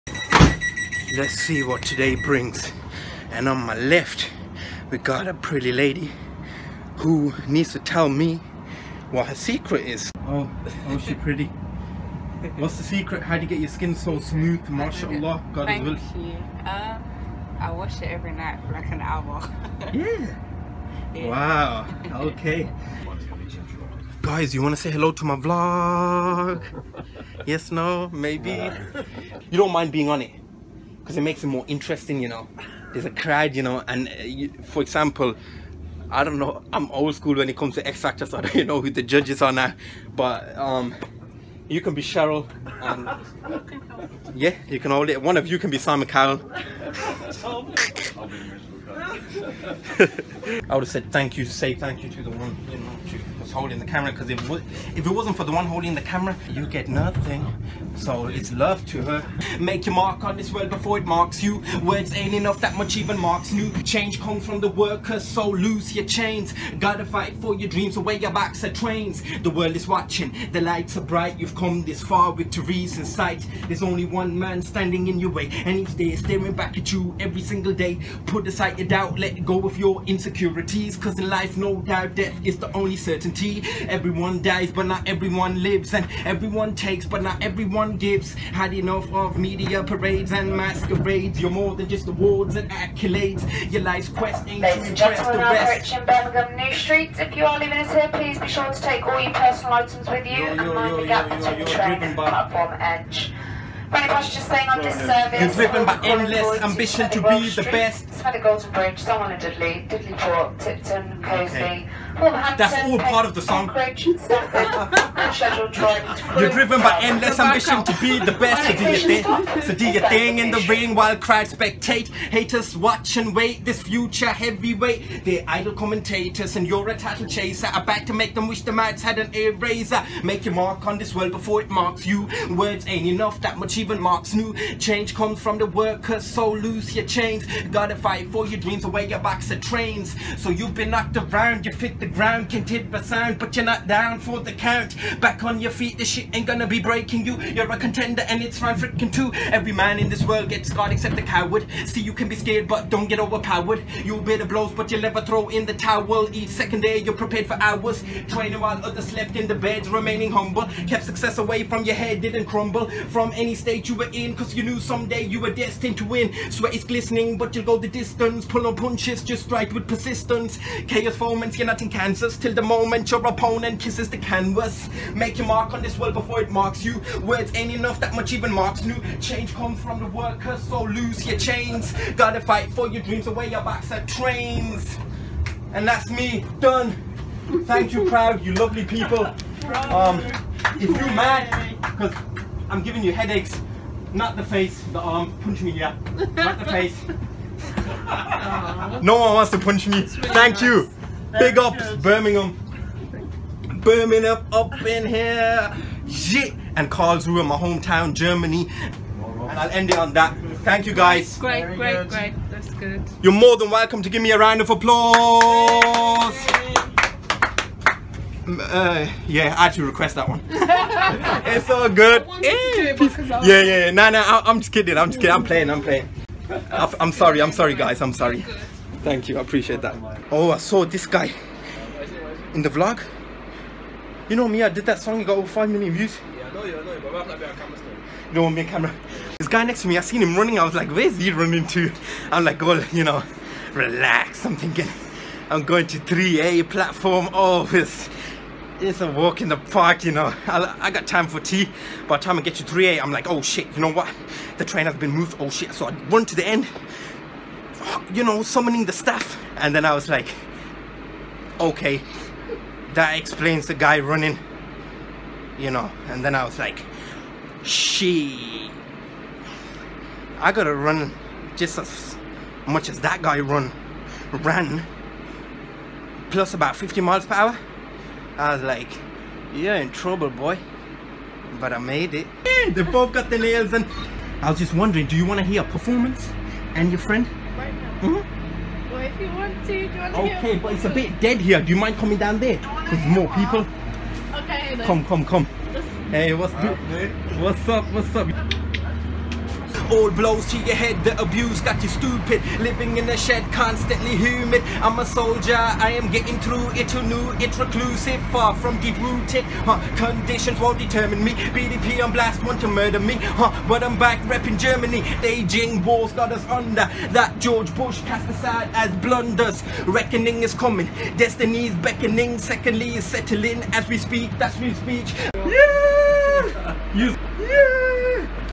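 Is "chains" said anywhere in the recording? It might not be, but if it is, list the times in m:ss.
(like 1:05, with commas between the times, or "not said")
1:06, 2:17, 3:01.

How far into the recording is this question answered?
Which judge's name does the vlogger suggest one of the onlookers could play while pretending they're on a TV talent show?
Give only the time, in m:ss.
0:42.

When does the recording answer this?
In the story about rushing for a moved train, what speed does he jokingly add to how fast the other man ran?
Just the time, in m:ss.
4:36.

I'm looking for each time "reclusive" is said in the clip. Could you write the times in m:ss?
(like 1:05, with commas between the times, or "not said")
5:07.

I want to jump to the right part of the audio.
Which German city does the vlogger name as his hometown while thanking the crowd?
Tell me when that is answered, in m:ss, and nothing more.
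3:26.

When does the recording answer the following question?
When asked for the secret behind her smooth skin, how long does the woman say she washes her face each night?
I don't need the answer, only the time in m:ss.
0:18.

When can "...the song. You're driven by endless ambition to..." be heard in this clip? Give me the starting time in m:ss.
1:53.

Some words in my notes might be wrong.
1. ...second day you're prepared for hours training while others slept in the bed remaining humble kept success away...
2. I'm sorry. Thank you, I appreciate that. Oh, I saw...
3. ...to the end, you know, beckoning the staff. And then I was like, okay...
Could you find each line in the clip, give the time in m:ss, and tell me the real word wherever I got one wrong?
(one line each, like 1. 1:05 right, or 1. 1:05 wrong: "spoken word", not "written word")
1. 2:36 right
2. 3:48 right
3. 4:16 wrong: "summoning", not "beckoning".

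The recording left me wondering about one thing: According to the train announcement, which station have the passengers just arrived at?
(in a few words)
Birmingham New Street.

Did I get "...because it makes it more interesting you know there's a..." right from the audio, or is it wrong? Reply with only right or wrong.
right.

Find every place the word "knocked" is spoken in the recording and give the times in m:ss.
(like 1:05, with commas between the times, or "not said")
2:20.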